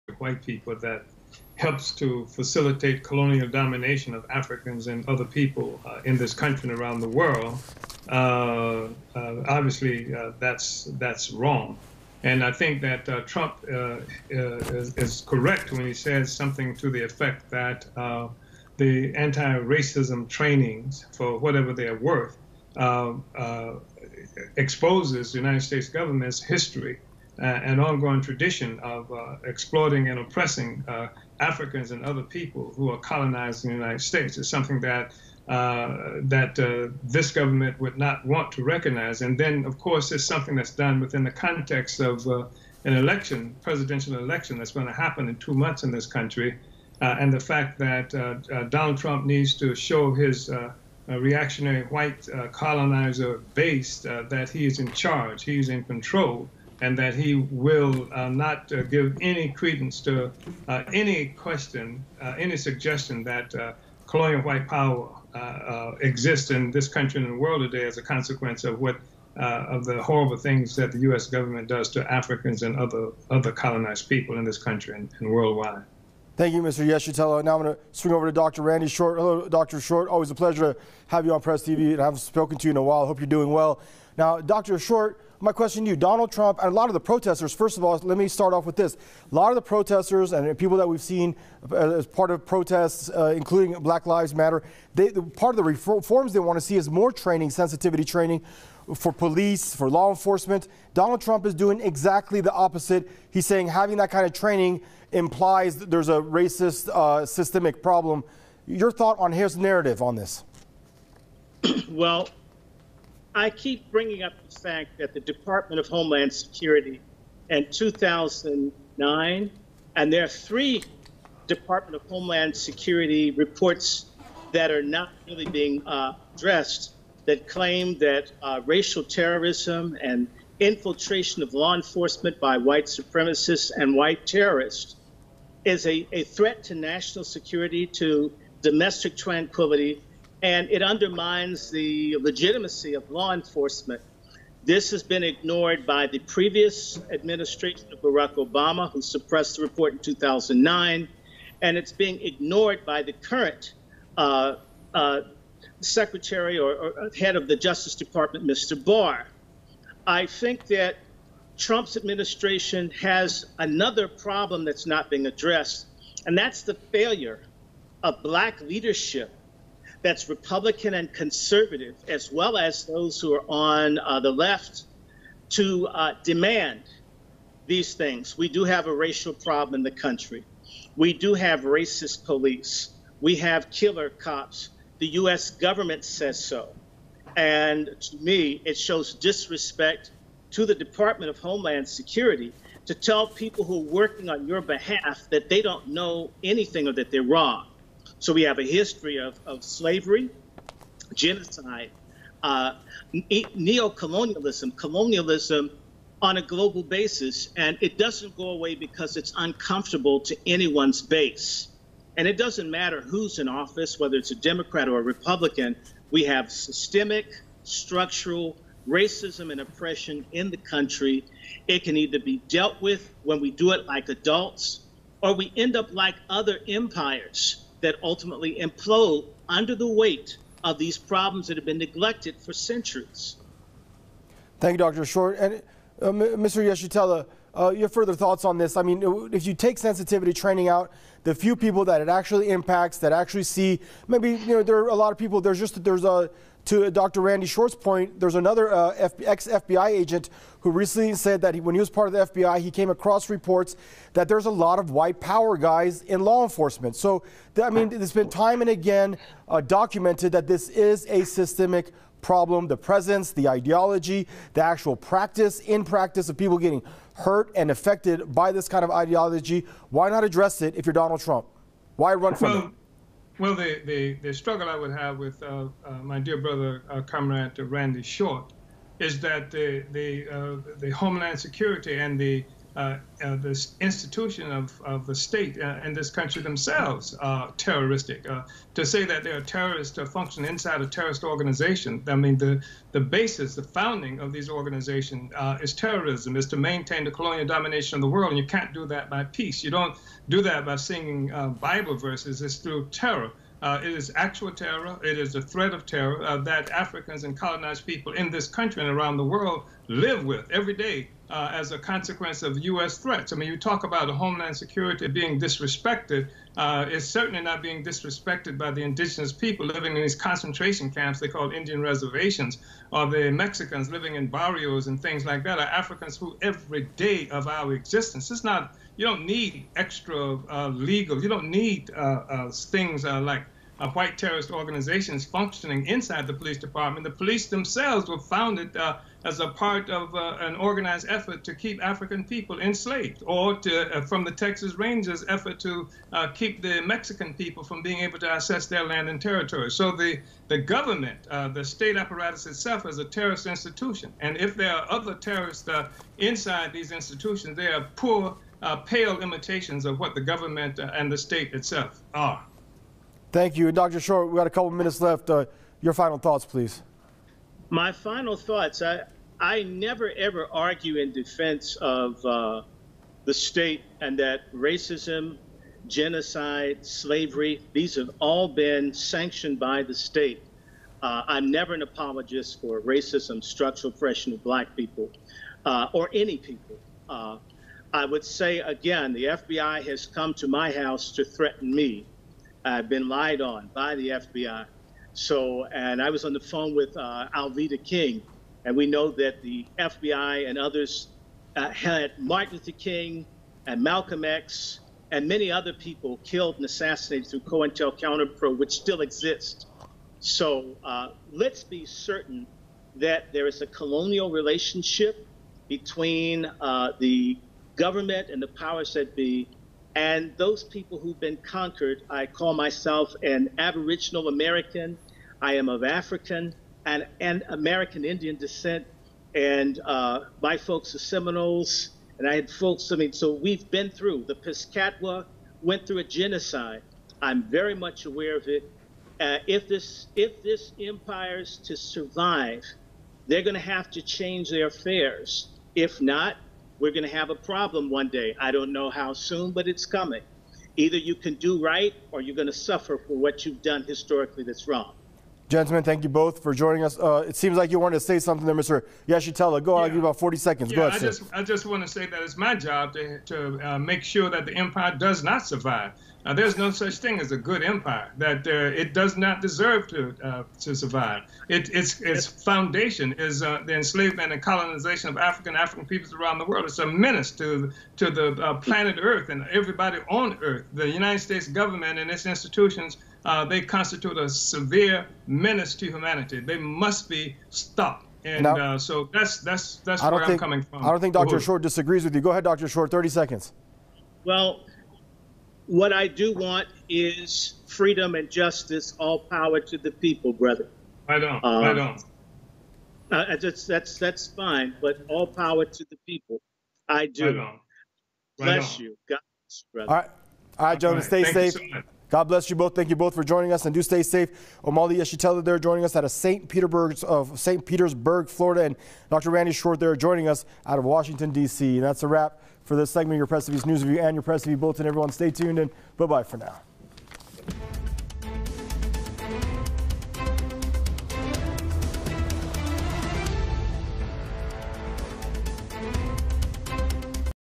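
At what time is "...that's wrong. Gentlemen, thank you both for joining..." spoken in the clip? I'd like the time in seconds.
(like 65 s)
454 s.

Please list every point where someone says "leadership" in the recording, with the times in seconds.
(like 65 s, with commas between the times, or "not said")
168 s.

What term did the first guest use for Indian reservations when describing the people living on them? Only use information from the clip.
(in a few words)
concentration camps.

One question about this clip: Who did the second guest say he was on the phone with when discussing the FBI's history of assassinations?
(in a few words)
Alveda King.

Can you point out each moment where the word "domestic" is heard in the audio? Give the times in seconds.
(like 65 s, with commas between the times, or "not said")
138 s.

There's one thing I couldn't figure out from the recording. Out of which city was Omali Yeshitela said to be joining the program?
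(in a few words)
St. Petersburg, Florida.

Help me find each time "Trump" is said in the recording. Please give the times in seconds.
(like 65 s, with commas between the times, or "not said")
13 s, 48 s, 86 s, 101 s, 161 s, 271 s.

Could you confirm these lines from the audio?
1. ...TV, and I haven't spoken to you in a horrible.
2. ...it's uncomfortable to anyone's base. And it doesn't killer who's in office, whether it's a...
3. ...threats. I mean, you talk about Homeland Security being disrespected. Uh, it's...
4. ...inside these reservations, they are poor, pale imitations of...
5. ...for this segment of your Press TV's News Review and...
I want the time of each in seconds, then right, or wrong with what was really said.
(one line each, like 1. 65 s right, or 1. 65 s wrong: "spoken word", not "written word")
1. 81 s wrong: "while", not "horrible"
2. 209 s wrong: "matter", not "killer"
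3. 312 s right
4. 356 s wrong: "institutions", not "reservations"
5. 522 s right.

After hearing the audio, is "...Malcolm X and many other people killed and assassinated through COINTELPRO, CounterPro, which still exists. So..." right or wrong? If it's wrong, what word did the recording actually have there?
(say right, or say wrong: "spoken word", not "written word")
right.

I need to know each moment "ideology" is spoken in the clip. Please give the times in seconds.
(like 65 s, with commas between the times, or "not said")
263 s, 268 s.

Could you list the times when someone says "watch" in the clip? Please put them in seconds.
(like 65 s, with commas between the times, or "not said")
not said.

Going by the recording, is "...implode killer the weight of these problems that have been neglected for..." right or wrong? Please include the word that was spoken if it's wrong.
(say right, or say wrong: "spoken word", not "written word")
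wrong: "under", not "killer".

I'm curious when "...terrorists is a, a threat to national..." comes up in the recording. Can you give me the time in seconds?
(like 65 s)
134 s.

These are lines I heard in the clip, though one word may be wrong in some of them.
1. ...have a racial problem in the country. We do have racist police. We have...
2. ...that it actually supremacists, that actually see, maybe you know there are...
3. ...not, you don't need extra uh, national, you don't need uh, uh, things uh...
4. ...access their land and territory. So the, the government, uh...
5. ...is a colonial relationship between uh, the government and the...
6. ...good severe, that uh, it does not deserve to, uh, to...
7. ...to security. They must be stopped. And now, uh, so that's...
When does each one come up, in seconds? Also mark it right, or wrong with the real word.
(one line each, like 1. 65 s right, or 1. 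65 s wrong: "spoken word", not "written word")
1. 178 s right
2. 241 s wrong: "impacts", not "supremacists"
3. 328 s wrong: "legal", not "national"
4. 348 s right
5. 413 s right
6. 467 s wrong: "empire", not "severe"
7. 485 s wrong: "humanity", not "security".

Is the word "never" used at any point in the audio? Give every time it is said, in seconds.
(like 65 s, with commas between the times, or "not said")
369 s, 381 s.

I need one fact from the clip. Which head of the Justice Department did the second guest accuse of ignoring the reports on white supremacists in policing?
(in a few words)
Barr.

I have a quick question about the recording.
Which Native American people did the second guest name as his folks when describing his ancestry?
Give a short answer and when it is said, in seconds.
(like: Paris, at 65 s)
Seminoles, at 430 s.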